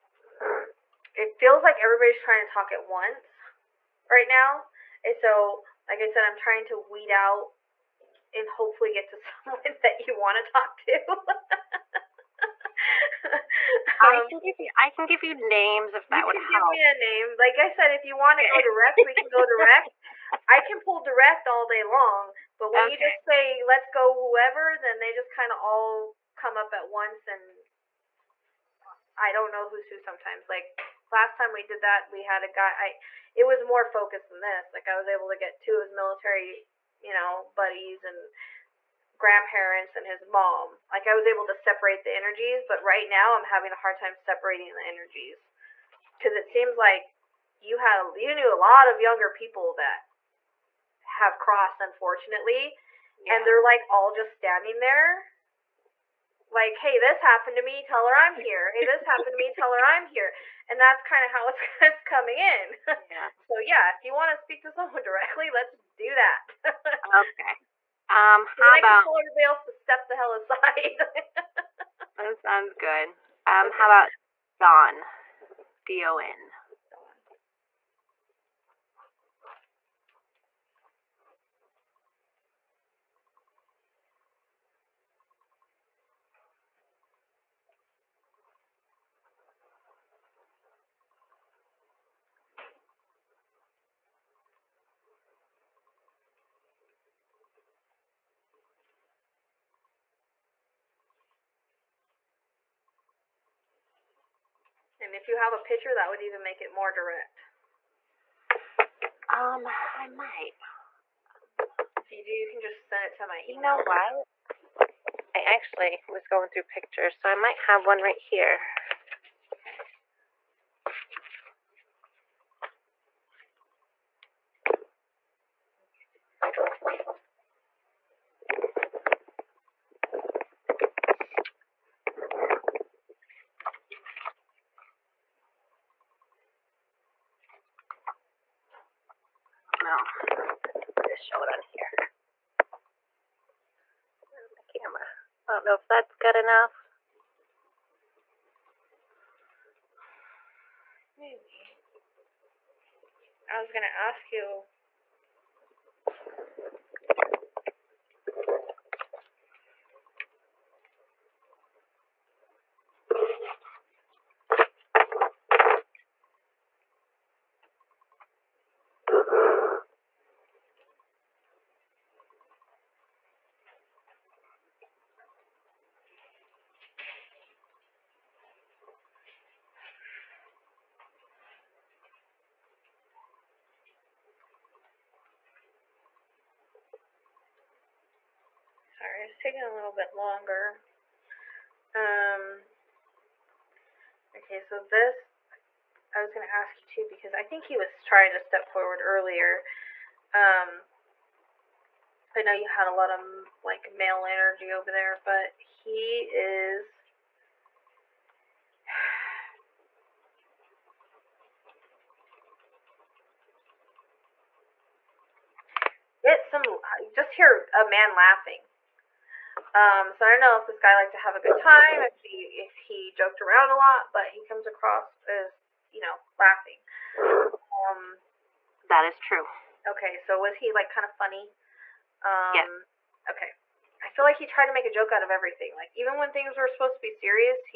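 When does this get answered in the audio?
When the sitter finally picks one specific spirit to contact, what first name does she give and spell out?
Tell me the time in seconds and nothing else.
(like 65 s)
74 s.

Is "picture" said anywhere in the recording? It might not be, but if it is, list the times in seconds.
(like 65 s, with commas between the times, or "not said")
105 s, 116 s.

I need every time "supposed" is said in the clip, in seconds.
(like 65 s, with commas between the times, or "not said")
236 s.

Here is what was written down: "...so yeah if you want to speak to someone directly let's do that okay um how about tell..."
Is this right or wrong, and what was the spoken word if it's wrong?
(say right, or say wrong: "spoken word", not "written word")
right.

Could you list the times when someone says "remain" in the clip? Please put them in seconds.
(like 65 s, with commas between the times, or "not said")
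not said.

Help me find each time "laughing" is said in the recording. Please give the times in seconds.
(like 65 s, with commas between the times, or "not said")
218 s, 226 s.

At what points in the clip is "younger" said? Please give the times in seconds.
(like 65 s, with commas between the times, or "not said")
48 s.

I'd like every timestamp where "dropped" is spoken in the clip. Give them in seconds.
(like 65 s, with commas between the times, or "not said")
not said.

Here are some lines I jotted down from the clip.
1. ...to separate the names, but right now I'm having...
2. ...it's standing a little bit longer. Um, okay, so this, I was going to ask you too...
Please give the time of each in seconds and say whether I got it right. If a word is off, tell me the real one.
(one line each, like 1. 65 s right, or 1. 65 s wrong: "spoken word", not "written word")
1. 41 s wrong: "energies", not "names"
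2. 189 s wrong: "taking", not "standing".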